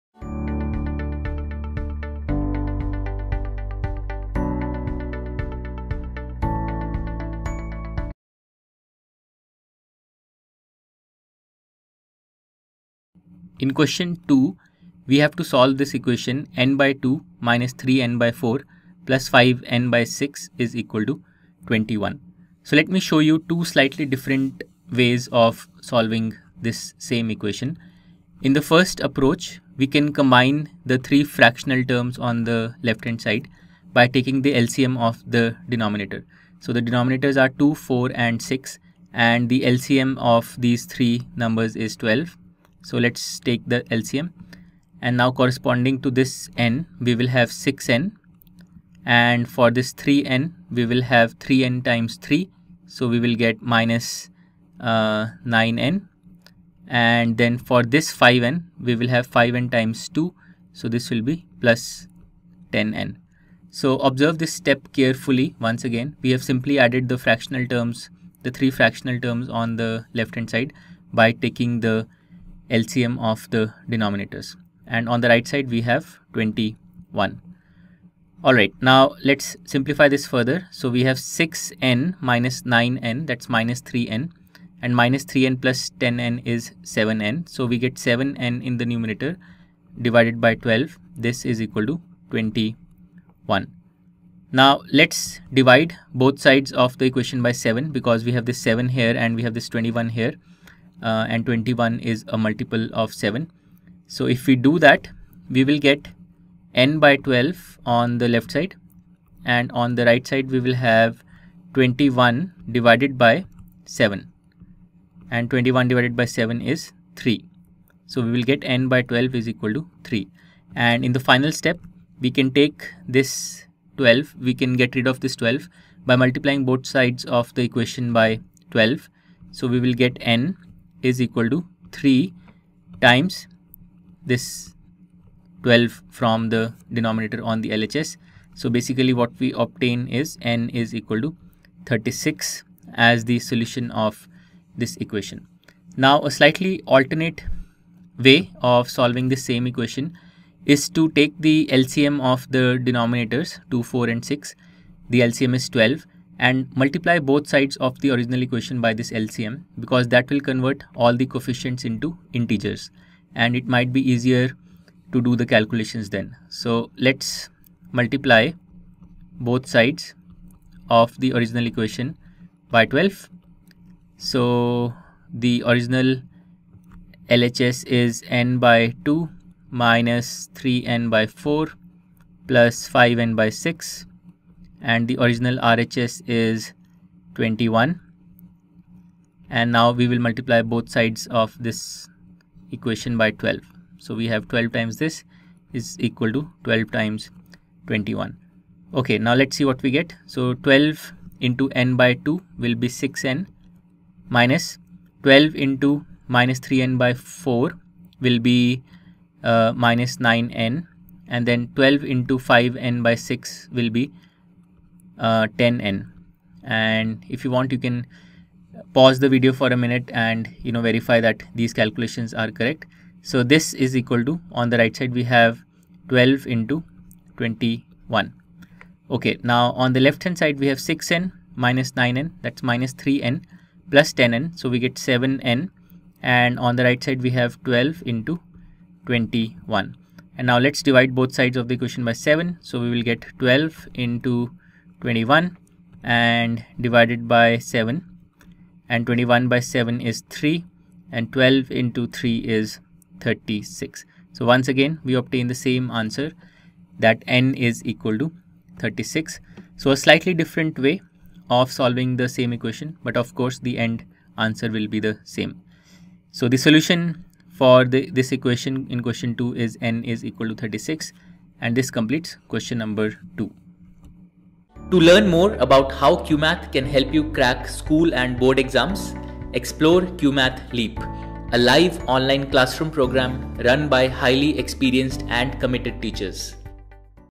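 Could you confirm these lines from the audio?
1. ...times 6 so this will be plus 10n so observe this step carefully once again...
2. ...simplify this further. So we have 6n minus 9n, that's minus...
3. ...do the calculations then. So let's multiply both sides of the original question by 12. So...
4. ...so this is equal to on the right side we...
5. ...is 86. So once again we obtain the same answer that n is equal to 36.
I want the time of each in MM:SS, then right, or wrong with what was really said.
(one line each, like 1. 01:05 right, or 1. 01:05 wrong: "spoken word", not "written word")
1. 00:59 wrong: "2", not "6"
2. 01:19 right
3. 02:45 wrong: "equation", not "question"
4. 03:43 right
5. 04:12 wrong: "36", not "86".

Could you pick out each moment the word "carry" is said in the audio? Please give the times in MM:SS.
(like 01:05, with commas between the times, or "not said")
not said.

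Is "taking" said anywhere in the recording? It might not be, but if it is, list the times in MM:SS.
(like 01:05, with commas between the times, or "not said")
00:34, 01:11.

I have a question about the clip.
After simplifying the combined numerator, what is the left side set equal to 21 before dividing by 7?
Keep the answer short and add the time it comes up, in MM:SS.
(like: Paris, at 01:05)
7n/12, at 01:27.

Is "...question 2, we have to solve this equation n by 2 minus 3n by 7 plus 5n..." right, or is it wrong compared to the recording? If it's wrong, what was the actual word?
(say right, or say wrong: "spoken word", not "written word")
wrong: "4", not "7".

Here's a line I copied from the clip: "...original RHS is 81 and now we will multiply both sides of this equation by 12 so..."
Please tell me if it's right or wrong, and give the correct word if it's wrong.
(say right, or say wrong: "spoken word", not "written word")
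wrong: "21", not "81".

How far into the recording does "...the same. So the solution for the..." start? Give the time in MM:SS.
04:24.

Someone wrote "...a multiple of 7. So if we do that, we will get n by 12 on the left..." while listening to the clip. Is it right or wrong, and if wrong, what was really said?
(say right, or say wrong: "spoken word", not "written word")
right.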